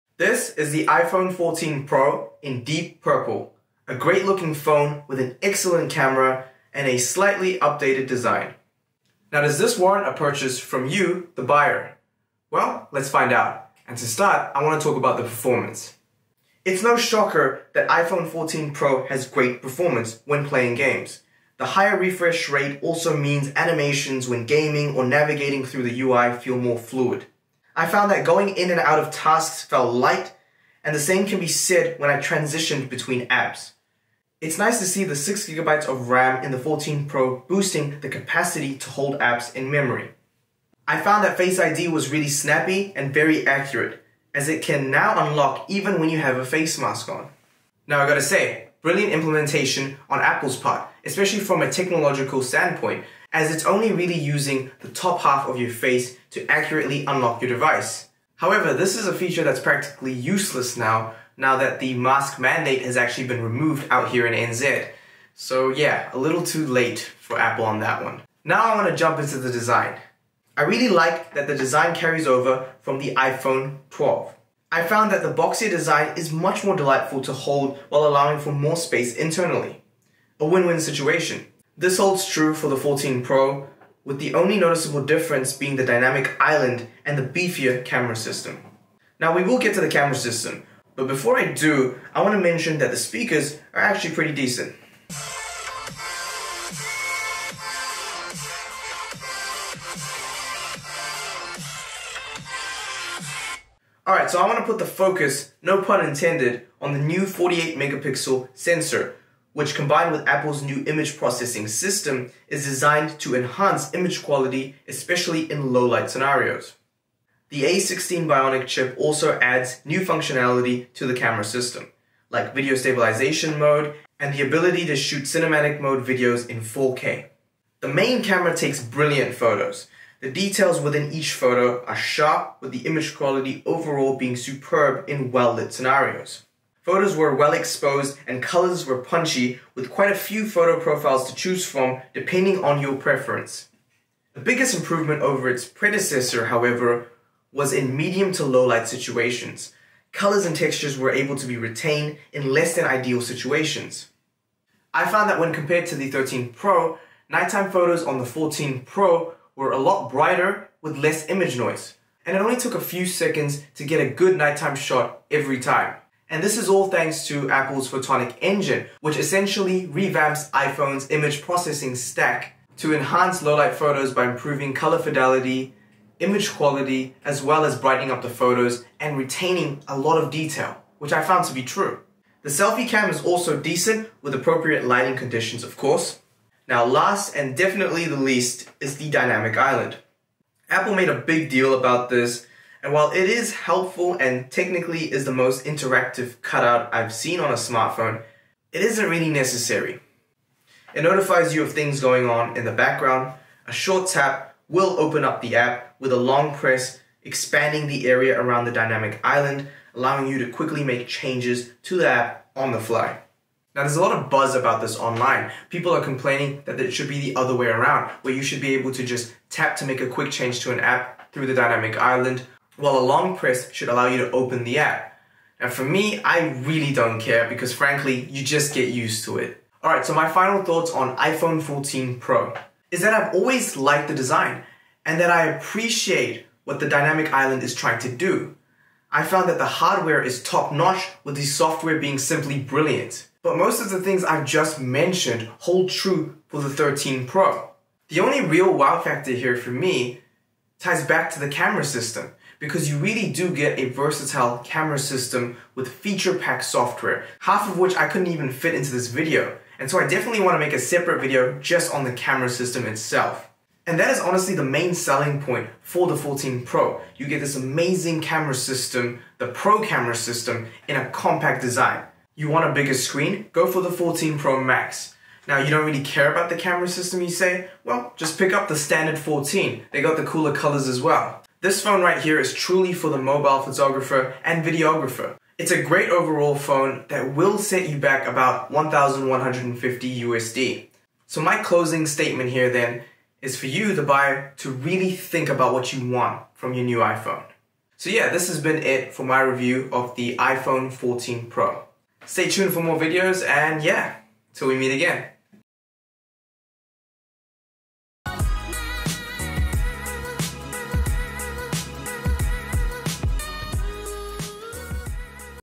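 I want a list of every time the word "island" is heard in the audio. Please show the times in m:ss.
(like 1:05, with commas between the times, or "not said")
1:26, 3:09, 3:29, 3:41, 3:57.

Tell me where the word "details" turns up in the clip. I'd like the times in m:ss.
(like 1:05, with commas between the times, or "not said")
2:10, 3:00.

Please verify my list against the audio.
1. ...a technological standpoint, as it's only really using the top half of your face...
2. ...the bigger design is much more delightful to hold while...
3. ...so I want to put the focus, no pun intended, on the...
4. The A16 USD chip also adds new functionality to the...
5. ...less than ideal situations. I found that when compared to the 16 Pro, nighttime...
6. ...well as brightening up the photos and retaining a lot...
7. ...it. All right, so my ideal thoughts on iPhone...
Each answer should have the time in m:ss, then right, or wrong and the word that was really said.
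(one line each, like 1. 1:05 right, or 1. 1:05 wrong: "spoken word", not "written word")
1. 0:51 right
2. 1:15 wrong: "boxier", not "bigger"
3. 1:44 right
4. 1:57 wrong: "Bionic", not "USD"
5. 2:32 wrong: "13", not "16"
6. 2:57 right
7. 3:49 wrong: "final", not "ideal".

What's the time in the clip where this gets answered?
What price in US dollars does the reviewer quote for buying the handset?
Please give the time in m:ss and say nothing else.
4:48.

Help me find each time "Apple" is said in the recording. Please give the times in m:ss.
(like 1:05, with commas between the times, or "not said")
0:50, 1:07, 1:50, 2:47, 3:10.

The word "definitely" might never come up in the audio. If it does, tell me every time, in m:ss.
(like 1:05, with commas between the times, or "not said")
3:07, 4:20.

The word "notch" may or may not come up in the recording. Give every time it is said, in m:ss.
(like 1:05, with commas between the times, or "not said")
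4:00.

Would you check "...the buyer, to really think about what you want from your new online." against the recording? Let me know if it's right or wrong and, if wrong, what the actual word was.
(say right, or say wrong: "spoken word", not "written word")
wrong: "iPhone", not "online".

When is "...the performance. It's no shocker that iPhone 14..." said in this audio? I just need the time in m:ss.
0:15.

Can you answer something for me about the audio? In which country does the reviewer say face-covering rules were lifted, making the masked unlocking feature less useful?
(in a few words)
NZ.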